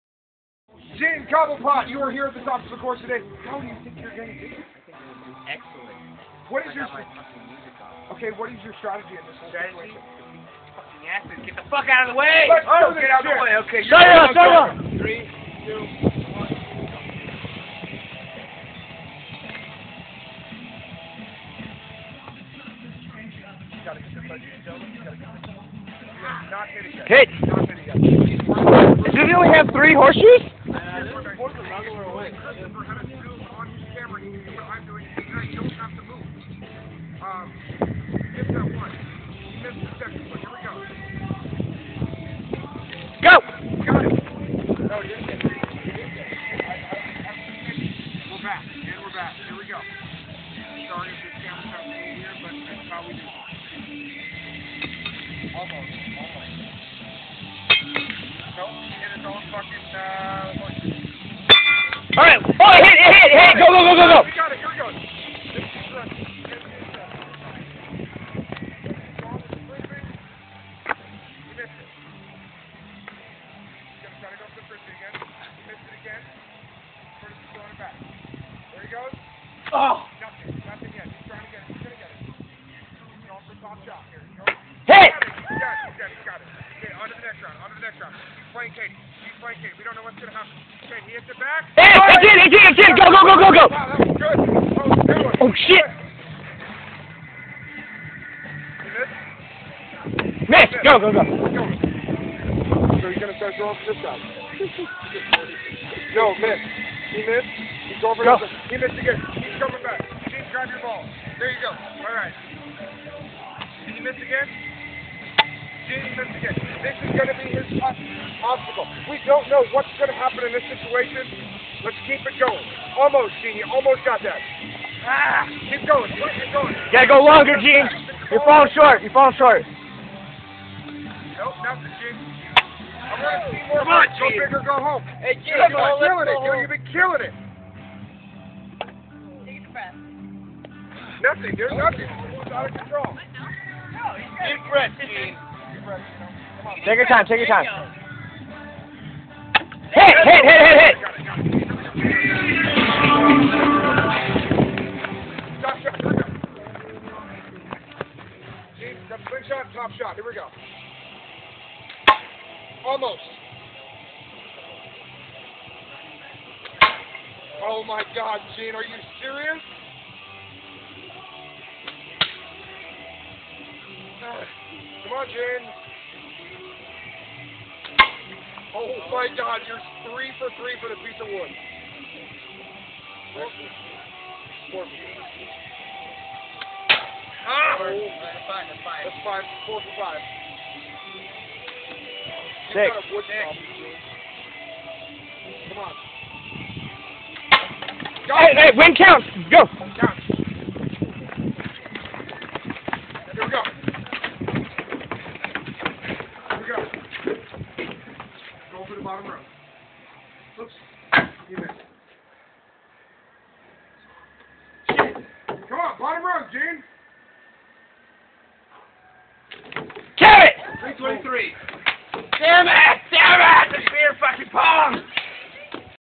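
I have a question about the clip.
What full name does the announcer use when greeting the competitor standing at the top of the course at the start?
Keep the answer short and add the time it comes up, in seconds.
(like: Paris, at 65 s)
James Cobblepot, at 1 s.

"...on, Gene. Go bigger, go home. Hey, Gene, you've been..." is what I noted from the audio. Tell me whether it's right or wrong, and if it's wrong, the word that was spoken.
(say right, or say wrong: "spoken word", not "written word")
right.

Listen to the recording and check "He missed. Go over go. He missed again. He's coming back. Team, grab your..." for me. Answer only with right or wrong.
right.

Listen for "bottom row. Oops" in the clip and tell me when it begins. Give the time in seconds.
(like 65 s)
209 s.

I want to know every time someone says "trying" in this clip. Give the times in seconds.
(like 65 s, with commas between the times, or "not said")
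81 s.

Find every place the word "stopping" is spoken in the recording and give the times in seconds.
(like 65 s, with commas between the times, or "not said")
not said.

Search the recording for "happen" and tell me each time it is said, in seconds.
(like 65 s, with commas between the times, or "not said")
90 s, 120 s.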